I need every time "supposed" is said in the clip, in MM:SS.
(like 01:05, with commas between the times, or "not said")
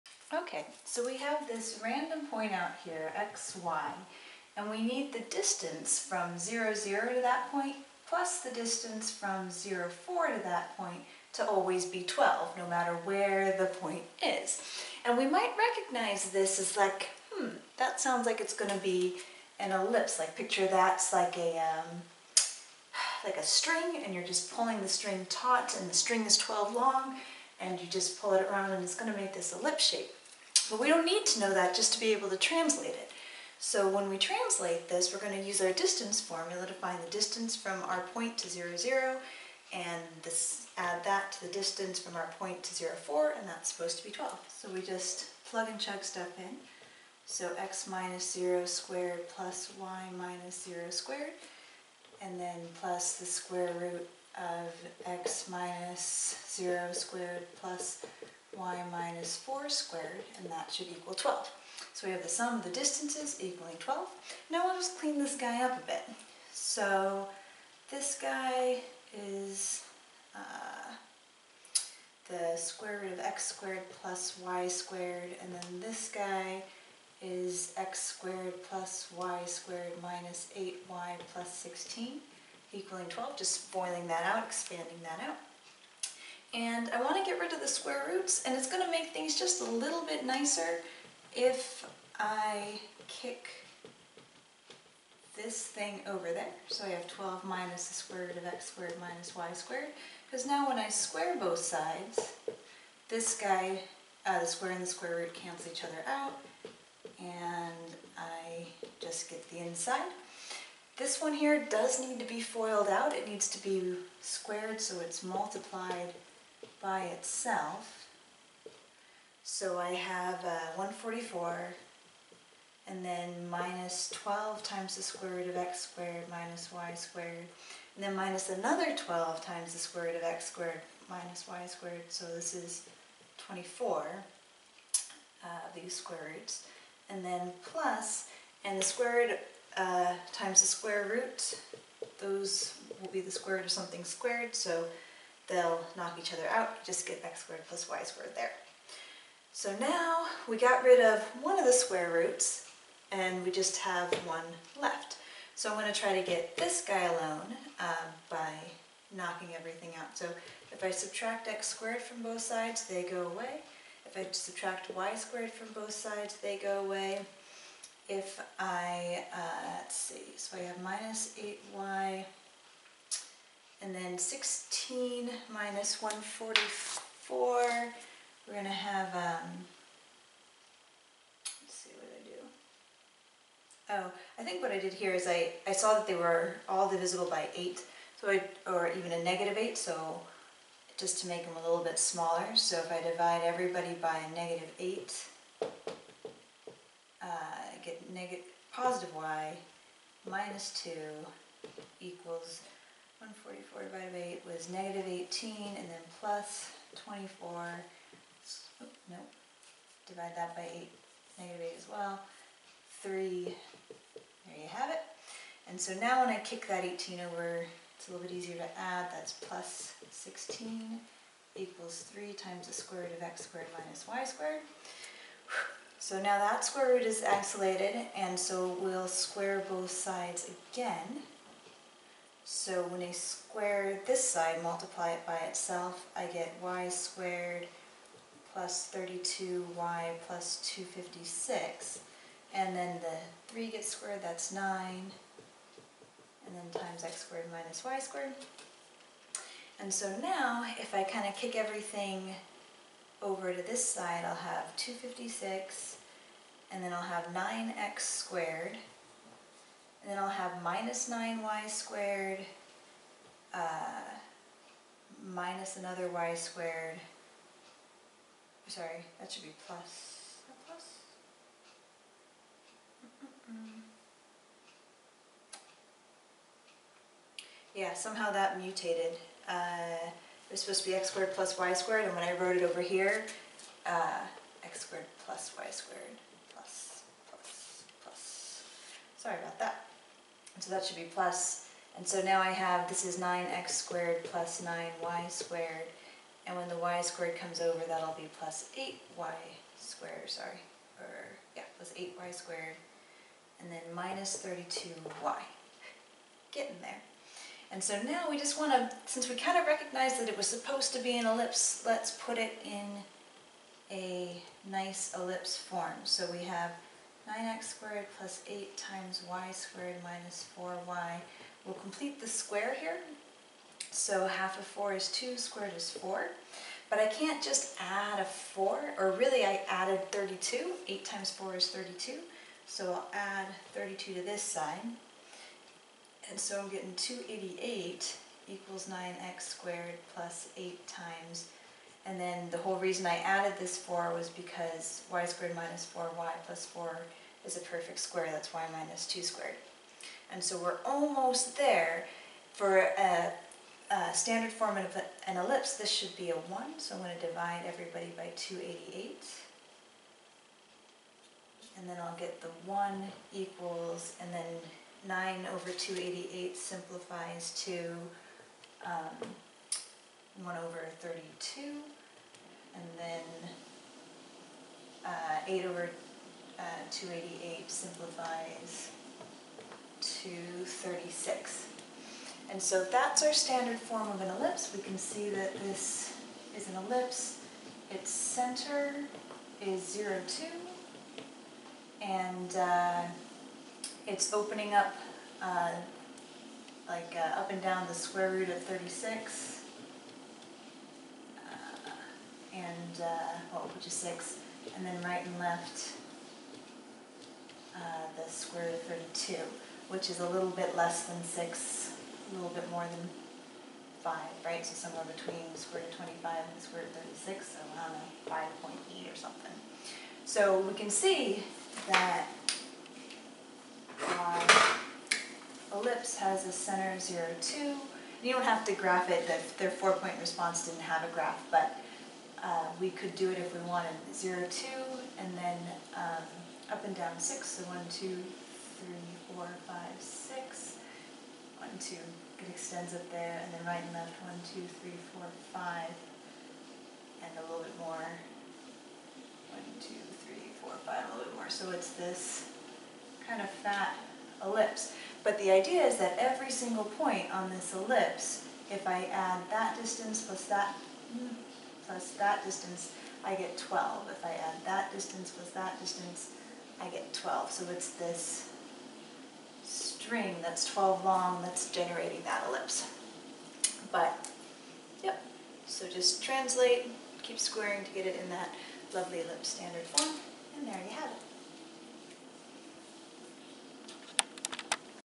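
00:43, 04:40, 05:10.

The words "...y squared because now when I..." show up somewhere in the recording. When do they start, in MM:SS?
01:39.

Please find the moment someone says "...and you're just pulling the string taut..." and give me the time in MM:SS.
00:24.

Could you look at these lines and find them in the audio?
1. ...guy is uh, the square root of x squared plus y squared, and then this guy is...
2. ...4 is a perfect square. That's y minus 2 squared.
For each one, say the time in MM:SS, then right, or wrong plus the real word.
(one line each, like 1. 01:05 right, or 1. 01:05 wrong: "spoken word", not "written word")
1. 01:08 right
2. 05:46 right.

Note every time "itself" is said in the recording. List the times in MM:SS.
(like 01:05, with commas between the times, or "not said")
01:57, 03:55.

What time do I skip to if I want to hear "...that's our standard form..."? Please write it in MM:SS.
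06:22.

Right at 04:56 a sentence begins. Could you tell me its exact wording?
And when the y squared comes over, that'll be plus 8y squared, sorry.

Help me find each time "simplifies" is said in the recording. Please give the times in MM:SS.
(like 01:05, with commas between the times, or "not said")
06:06, 06:17.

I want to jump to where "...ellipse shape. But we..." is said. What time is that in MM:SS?
00:29.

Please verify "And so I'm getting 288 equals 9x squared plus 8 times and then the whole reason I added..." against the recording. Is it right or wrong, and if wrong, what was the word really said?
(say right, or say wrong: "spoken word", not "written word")
right.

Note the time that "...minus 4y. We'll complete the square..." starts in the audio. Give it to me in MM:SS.
05:20.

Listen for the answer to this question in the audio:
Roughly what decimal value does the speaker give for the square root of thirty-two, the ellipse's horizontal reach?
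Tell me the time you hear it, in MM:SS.
06:58.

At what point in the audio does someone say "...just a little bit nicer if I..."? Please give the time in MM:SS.
01:29.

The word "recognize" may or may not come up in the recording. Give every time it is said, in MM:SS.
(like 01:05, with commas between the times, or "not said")
00:15, 05:09.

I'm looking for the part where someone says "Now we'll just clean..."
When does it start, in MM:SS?
01:04.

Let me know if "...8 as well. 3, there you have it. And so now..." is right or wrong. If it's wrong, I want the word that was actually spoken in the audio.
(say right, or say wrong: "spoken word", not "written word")
right.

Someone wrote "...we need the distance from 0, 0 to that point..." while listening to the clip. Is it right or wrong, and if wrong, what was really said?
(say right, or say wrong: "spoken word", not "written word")
right.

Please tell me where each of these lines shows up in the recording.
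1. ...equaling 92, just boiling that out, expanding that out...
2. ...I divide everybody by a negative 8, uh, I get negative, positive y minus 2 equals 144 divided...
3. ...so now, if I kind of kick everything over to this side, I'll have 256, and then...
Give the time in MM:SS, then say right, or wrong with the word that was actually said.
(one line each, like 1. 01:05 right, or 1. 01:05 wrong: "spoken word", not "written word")
1. 01:22 wrong: "12", not "92"
2. 03:12 right
3. 04:09 right.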